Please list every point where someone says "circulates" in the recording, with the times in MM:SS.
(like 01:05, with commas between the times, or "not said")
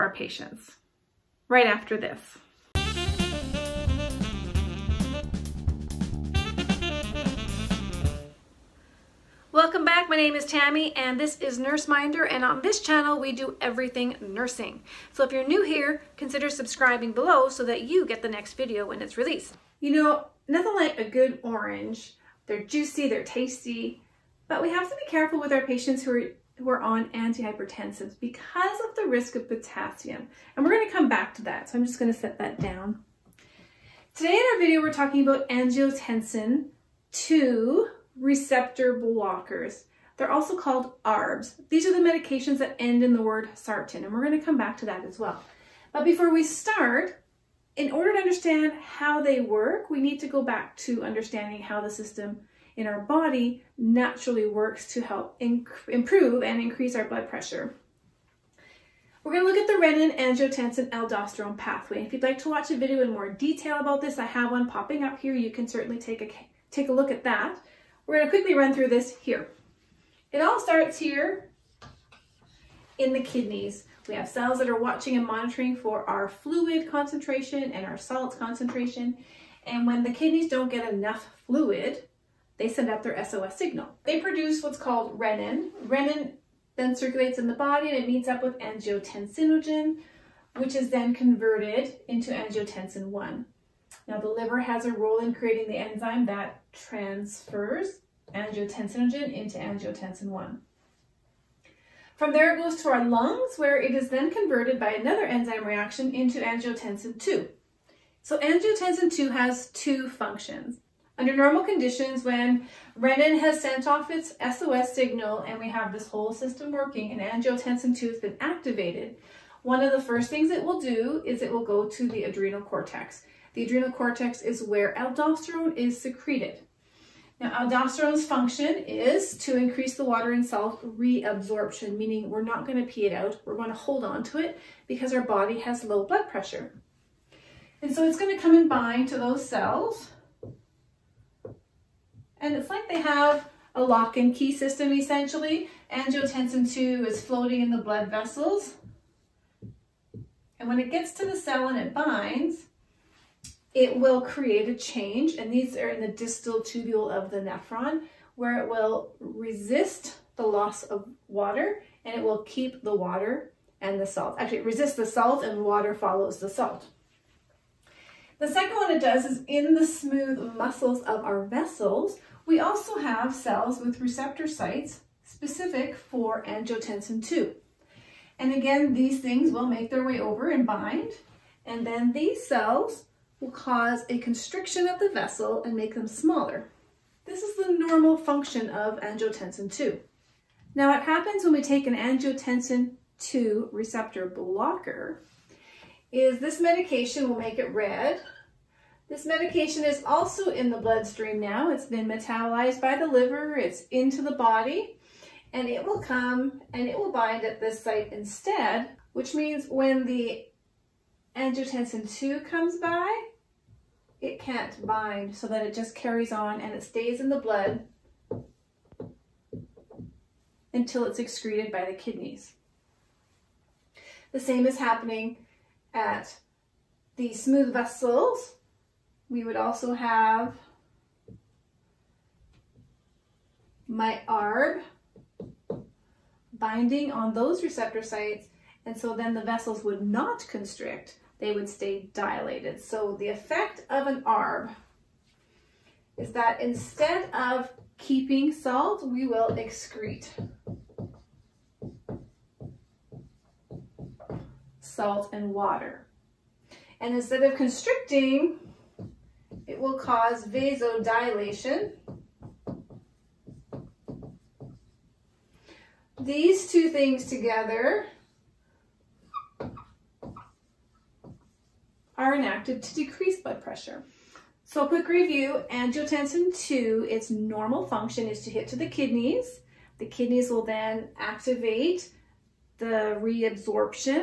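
01:26.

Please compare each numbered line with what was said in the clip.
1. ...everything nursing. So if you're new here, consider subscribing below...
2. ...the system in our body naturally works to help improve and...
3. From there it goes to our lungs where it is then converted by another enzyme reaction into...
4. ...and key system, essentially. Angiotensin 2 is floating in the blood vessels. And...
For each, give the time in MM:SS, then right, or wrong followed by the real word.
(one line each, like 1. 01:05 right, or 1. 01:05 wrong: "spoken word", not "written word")
1. 00:13 right
2. 00:51 right
3. 01:42 right
4. 02:24 right.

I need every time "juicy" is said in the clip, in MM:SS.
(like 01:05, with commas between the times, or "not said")
00:22.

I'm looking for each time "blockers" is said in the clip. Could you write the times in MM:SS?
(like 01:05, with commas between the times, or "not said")
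00:38, 03:14.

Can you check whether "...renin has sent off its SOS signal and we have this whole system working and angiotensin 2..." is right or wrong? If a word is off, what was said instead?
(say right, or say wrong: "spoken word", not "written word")
right.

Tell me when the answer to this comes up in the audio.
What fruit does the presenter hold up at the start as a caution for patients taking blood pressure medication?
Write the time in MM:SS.
00:21.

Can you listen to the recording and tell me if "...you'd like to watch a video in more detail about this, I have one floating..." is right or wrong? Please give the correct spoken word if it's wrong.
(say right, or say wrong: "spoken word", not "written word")
wrong: "popping", not "floating".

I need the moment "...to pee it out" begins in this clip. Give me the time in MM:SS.
02:12.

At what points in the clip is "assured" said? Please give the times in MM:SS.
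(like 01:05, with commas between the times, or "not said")
not said.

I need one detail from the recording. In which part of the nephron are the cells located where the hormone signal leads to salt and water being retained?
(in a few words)
Distal tubule.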